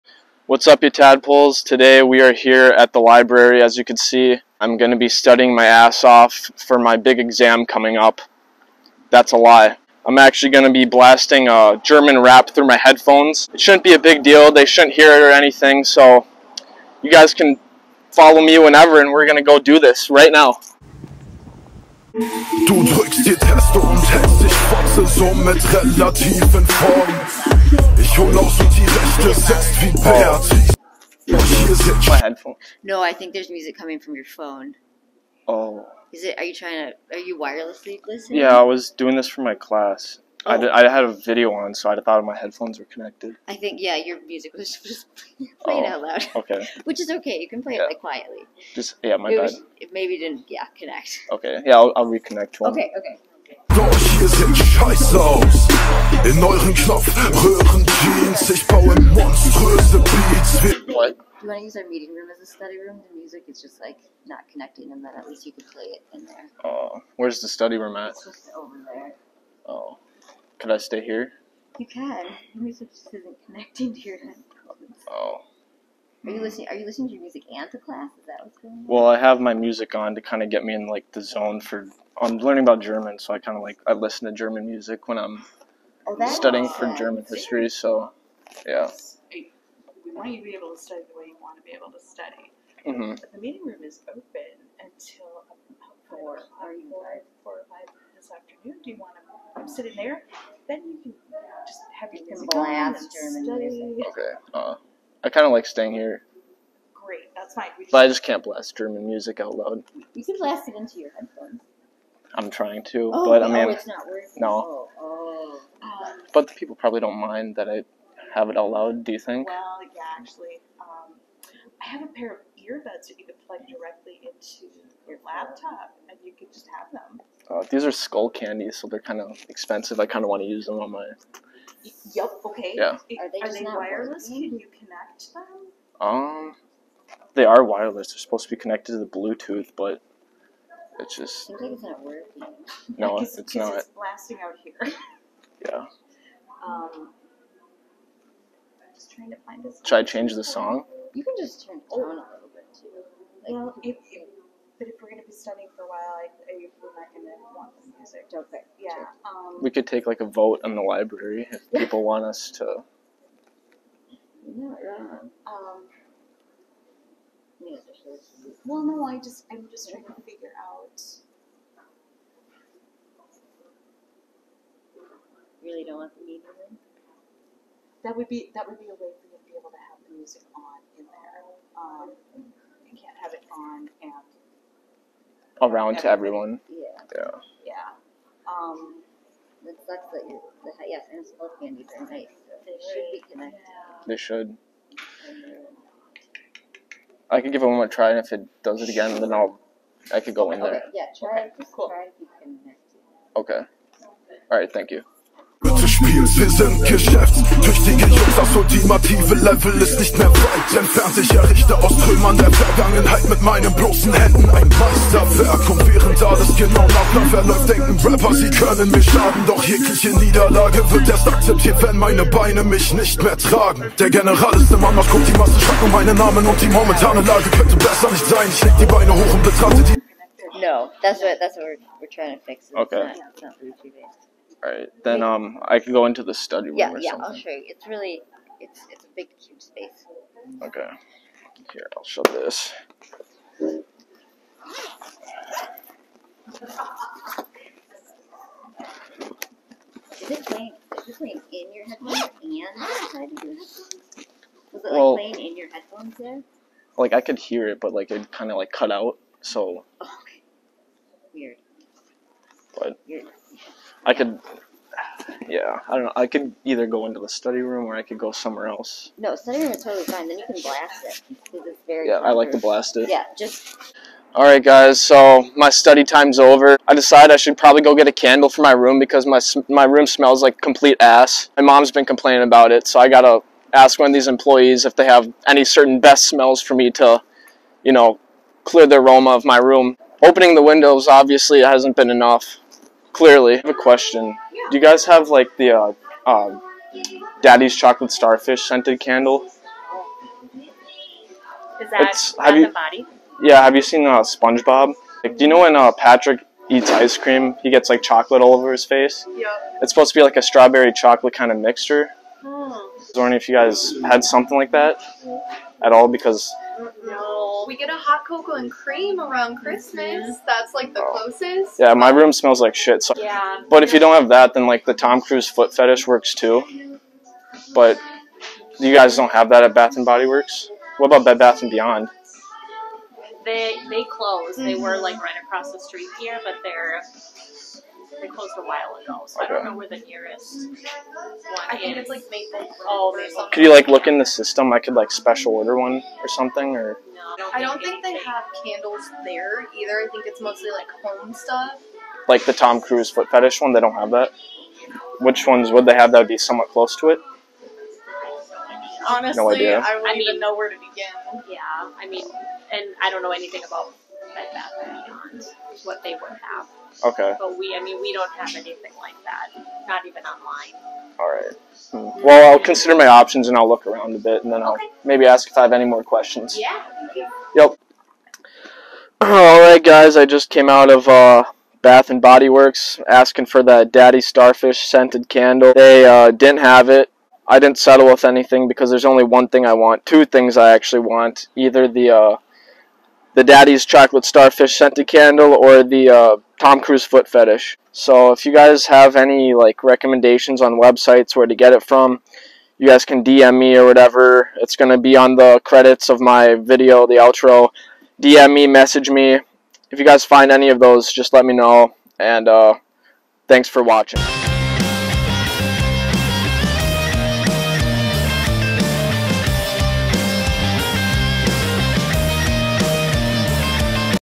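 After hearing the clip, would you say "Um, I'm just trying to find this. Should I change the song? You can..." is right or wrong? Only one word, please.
right.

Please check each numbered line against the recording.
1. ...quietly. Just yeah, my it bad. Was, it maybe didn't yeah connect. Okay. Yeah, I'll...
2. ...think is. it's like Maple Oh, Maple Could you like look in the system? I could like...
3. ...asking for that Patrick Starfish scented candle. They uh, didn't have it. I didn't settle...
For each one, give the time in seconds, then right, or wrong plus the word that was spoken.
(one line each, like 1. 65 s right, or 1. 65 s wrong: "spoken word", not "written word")
1. 47 s right
2. 341 s right
3. 383 s wrong: "Daddy", not "Patrick".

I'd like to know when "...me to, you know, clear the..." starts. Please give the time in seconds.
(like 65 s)
286 s.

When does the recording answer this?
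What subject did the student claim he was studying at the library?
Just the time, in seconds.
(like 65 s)
86 s.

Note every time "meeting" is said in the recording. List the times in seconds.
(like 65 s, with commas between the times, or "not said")
61 s, 93 s, 176 s.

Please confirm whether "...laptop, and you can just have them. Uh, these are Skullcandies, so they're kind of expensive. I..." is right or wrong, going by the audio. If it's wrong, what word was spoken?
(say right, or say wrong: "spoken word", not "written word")
right.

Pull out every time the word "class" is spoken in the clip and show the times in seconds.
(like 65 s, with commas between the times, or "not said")
39 s, 77 s.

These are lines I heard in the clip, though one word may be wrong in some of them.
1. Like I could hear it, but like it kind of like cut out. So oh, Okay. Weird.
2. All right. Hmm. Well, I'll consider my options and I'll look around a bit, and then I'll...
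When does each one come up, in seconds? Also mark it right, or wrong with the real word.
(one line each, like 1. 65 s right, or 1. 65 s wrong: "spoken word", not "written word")
1. 256 s right
2. 371 s right.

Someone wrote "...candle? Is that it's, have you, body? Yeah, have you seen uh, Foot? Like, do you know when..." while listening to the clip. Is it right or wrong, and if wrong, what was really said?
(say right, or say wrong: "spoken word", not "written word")
wrong: "SpongeBob", not "Foot".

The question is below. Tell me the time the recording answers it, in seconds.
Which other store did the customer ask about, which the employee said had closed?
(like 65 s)
331 s.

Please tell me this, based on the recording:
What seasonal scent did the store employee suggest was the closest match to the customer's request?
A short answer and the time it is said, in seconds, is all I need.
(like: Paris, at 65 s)
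Hot cocoa and cream, at 317 s.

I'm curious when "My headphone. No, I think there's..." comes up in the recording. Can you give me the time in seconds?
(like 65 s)
32 s.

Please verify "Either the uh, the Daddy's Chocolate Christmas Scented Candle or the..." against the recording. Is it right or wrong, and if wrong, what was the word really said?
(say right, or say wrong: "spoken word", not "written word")
wrong: "Starfish", not "Christmas".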